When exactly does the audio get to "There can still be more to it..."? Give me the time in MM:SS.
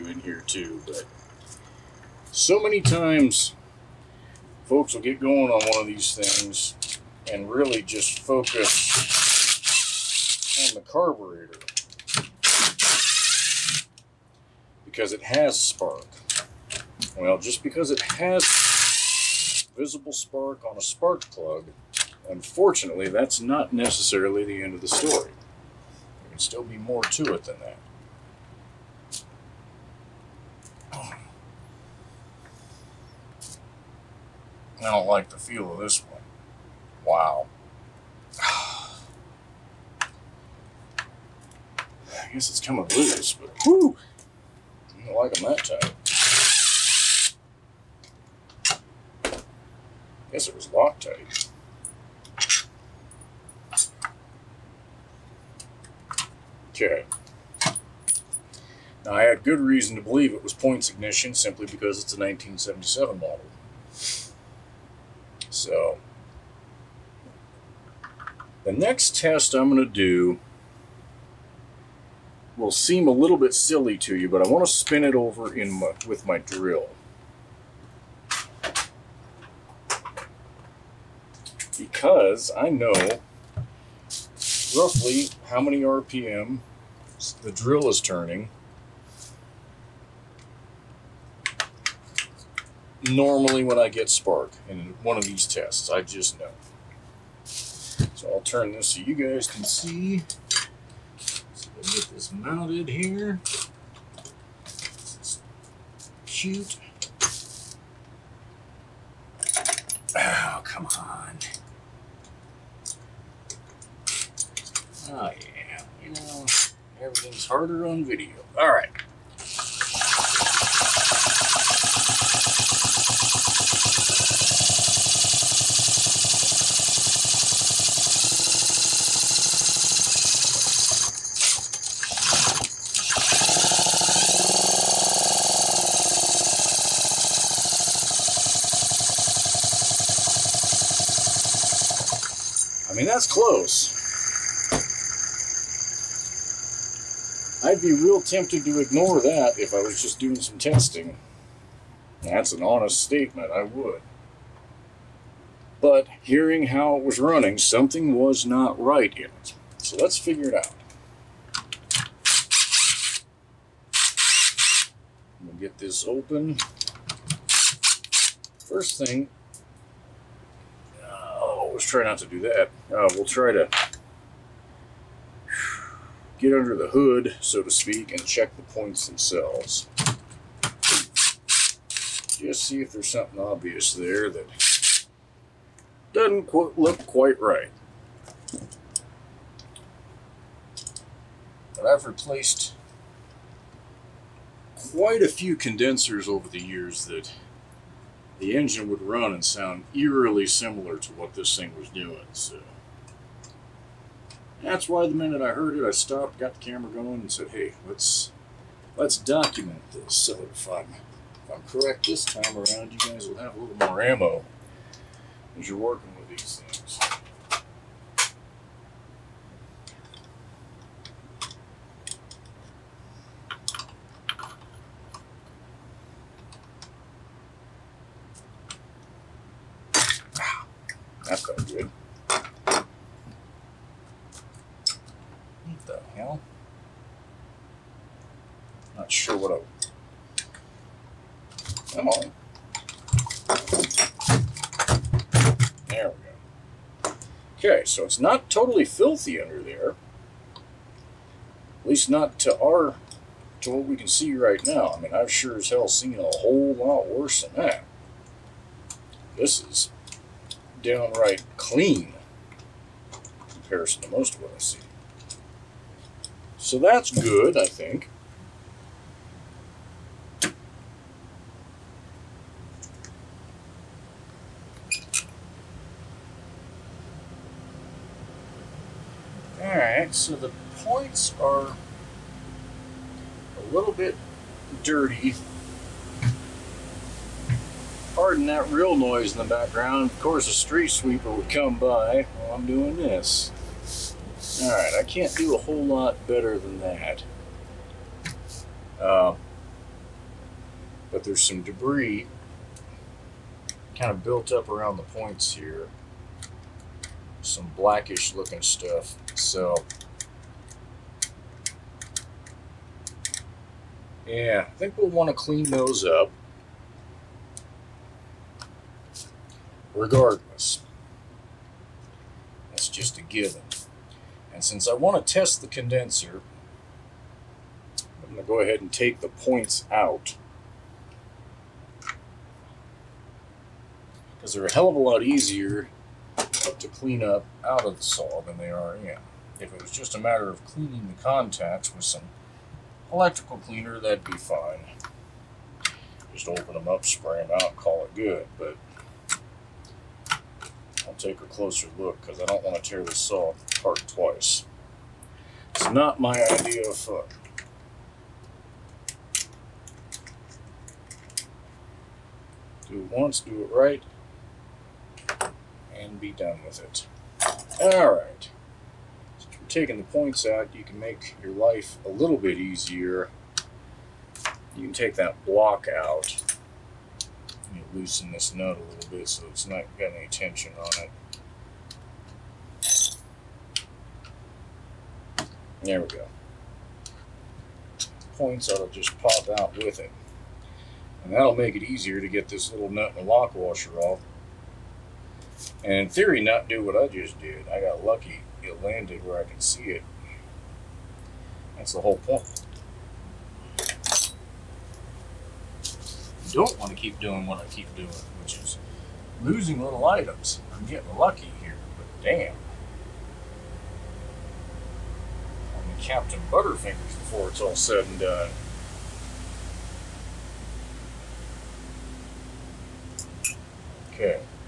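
00:25.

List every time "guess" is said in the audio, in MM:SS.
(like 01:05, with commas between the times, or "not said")
00:42, 00:50.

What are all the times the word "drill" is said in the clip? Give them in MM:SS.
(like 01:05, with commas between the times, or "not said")
01:16, 01:27.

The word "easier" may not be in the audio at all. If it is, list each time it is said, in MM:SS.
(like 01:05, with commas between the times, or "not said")
05:35, 06:12, 06:31.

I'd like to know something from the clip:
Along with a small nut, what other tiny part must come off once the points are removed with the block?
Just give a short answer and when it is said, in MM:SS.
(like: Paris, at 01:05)
lock washer, at 06:33.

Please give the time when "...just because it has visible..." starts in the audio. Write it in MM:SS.
00:17.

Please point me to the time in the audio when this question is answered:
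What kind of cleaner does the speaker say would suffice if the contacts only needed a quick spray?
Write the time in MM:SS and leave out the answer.
05:43.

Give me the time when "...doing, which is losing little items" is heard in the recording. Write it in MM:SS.
06:47.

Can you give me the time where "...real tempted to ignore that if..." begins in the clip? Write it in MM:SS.
02:27.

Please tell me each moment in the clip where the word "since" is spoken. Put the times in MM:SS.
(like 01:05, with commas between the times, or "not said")
05:24, 06:09.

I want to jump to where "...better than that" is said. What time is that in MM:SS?
04:56.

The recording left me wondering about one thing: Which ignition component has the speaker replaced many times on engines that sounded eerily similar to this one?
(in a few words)
condensers.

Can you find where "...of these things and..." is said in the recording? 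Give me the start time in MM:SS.
00:05.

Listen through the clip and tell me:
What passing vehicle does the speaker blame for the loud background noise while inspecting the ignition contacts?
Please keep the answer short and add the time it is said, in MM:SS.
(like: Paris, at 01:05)
street sweeper, at 04:50.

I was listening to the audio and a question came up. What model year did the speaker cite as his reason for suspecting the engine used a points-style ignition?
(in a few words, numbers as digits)
1977.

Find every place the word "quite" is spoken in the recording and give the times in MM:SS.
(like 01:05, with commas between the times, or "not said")
03:07, 03:14.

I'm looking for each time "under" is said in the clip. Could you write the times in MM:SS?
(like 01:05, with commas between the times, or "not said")
02:56, 04:09.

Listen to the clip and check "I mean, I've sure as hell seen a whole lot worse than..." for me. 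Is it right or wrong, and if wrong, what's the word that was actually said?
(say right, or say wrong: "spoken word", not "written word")
right.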